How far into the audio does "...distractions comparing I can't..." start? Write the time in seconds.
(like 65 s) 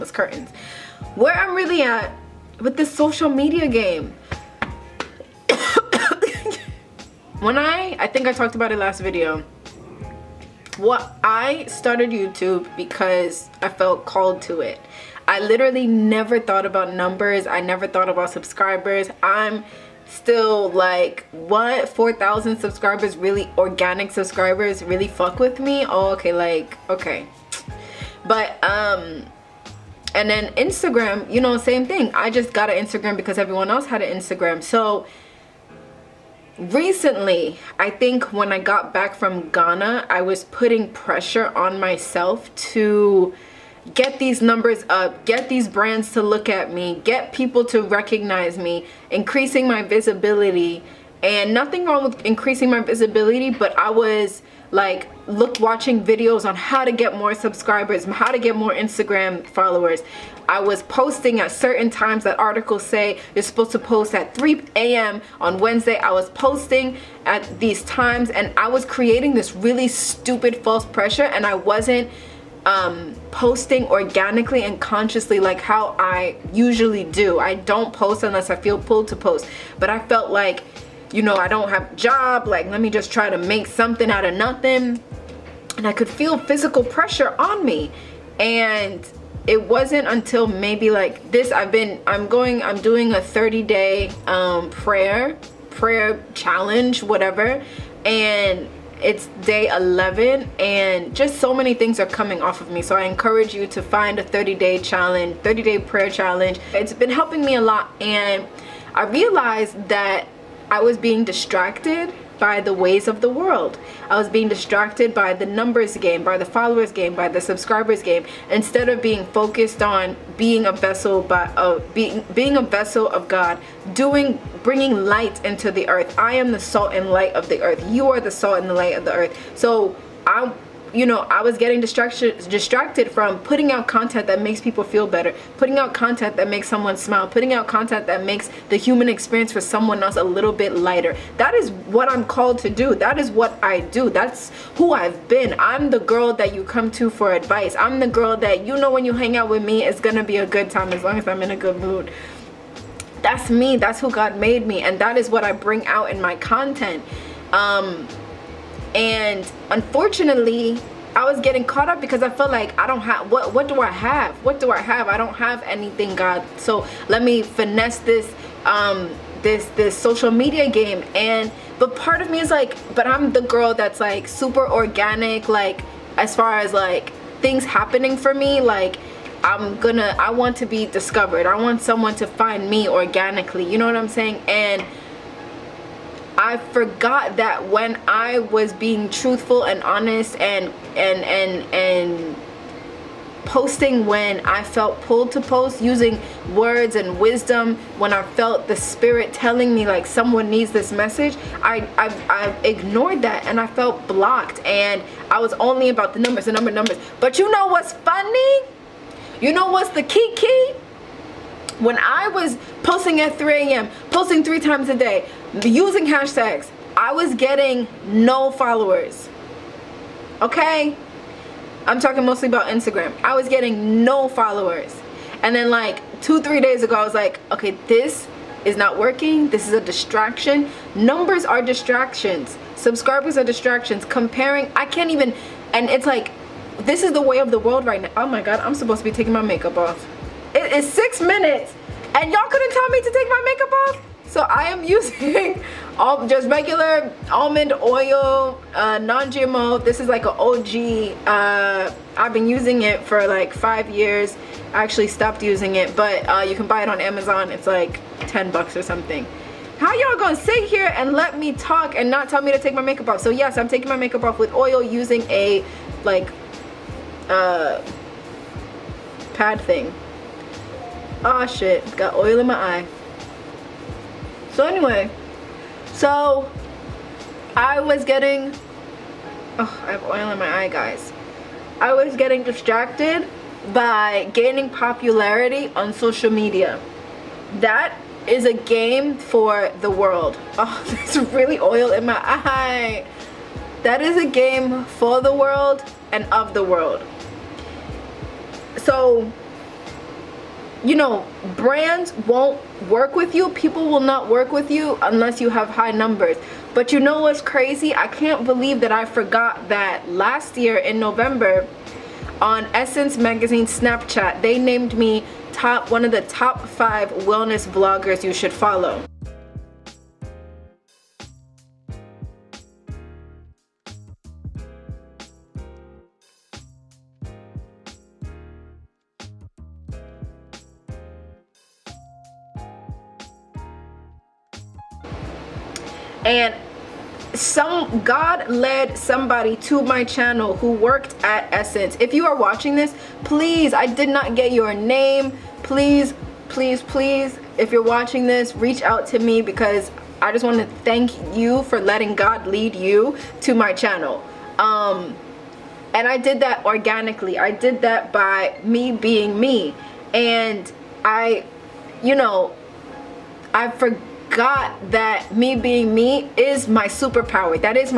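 233 s.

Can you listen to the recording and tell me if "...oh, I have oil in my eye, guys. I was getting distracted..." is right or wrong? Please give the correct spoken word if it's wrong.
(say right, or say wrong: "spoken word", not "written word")
right.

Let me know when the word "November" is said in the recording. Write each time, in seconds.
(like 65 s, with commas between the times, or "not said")
310 s.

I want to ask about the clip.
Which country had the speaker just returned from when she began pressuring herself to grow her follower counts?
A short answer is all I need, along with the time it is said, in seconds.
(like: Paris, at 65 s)
Ghana, at 39 s.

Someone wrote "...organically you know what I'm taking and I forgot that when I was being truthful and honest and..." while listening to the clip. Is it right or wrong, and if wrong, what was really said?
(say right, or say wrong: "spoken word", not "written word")
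wrong: "saying", not "taking".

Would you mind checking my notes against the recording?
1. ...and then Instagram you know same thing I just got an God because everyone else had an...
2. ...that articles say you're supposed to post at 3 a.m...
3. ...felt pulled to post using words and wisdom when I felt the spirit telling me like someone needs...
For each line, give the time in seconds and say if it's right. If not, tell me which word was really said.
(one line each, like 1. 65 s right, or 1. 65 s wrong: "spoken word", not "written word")
1. 30 s wrong: "Instagram", not "God"
2. 62 s right
3. 194 s right.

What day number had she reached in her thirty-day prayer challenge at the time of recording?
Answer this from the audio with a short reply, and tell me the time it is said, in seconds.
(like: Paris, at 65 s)
11, at 99 s.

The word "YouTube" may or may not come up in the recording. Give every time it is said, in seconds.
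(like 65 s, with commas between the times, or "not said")
12 s.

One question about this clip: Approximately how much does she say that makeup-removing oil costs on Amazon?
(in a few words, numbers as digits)
10 bucks.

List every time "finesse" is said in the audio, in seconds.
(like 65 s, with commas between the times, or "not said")
167 s.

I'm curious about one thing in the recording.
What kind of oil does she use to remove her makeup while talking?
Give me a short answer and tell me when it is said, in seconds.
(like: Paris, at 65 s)
almond oil, at 247 s.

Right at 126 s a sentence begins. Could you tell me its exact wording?
I am the salt and light of the earth.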